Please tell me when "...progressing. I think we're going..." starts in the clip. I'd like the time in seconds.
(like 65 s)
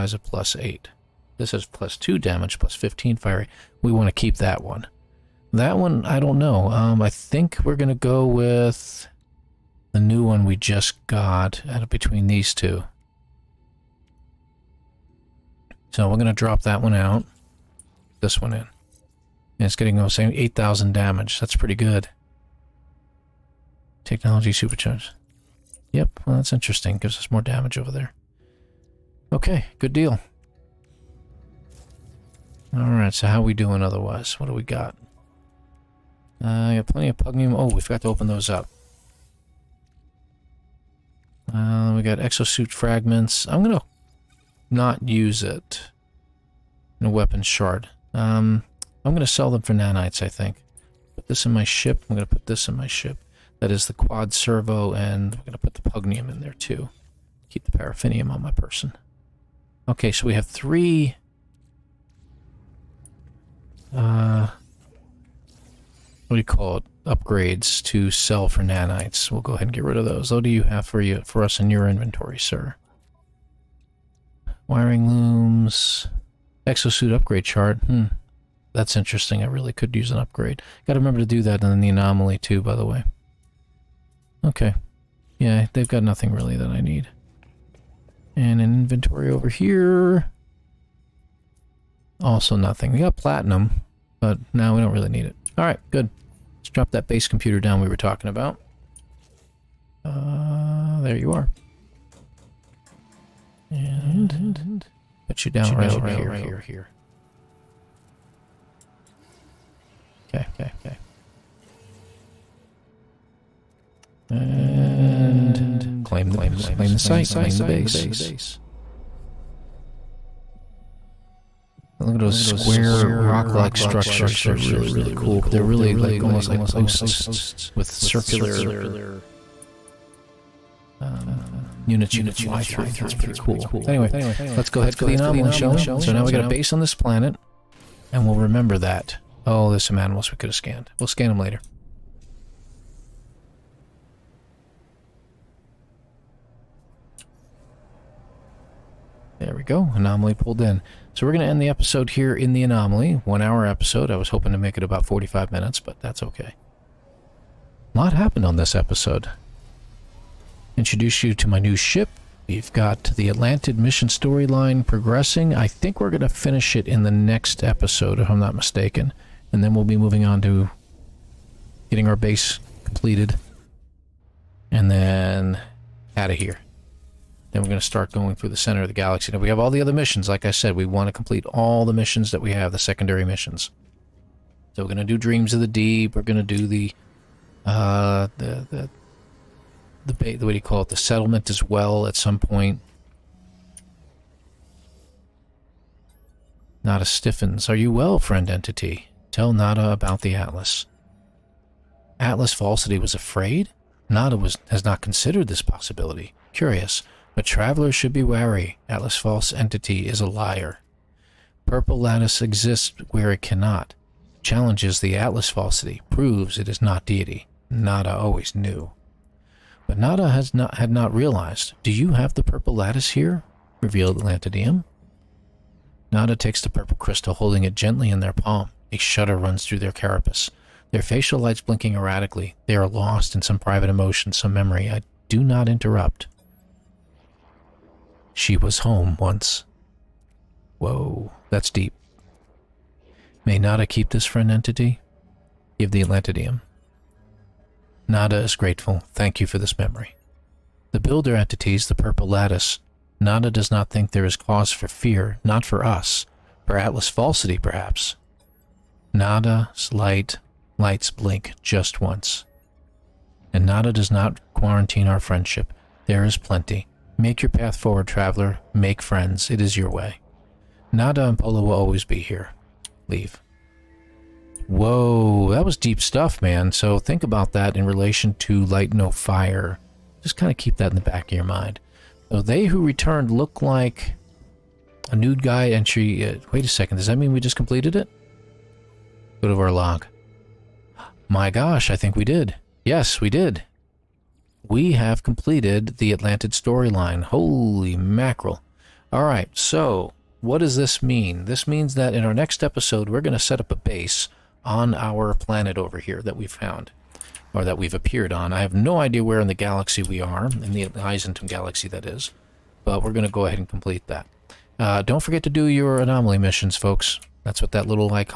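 164 s.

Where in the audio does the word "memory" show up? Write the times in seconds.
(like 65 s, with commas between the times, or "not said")
234 s, 249 s.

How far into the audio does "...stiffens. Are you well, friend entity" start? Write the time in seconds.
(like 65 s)
197 s.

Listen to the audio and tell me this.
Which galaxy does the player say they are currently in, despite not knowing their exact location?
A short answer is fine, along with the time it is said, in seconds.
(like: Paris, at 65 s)
Eissentam, at 310 s.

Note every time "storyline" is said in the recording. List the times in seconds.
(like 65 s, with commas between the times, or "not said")
164 s, 296 s.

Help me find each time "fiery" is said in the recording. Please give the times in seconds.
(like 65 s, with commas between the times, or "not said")
3 s.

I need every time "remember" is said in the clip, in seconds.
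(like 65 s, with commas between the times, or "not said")
80 s, 138 s.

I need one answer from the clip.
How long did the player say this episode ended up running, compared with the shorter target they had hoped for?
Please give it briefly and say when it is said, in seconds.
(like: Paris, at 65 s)
One hour, at 153 s.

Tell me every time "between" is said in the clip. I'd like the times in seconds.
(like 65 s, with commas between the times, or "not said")
11 s.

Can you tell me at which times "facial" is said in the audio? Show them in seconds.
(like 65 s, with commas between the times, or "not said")
230 s.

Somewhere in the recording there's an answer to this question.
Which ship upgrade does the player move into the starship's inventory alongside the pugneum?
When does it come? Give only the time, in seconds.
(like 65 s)
53 s.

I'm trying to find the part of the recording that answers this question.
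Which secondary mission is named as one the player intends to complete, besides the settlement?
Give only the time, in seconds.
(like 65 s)
185 s.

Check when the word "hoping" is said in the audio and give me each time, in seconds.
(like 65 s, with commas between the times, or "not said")
154 s.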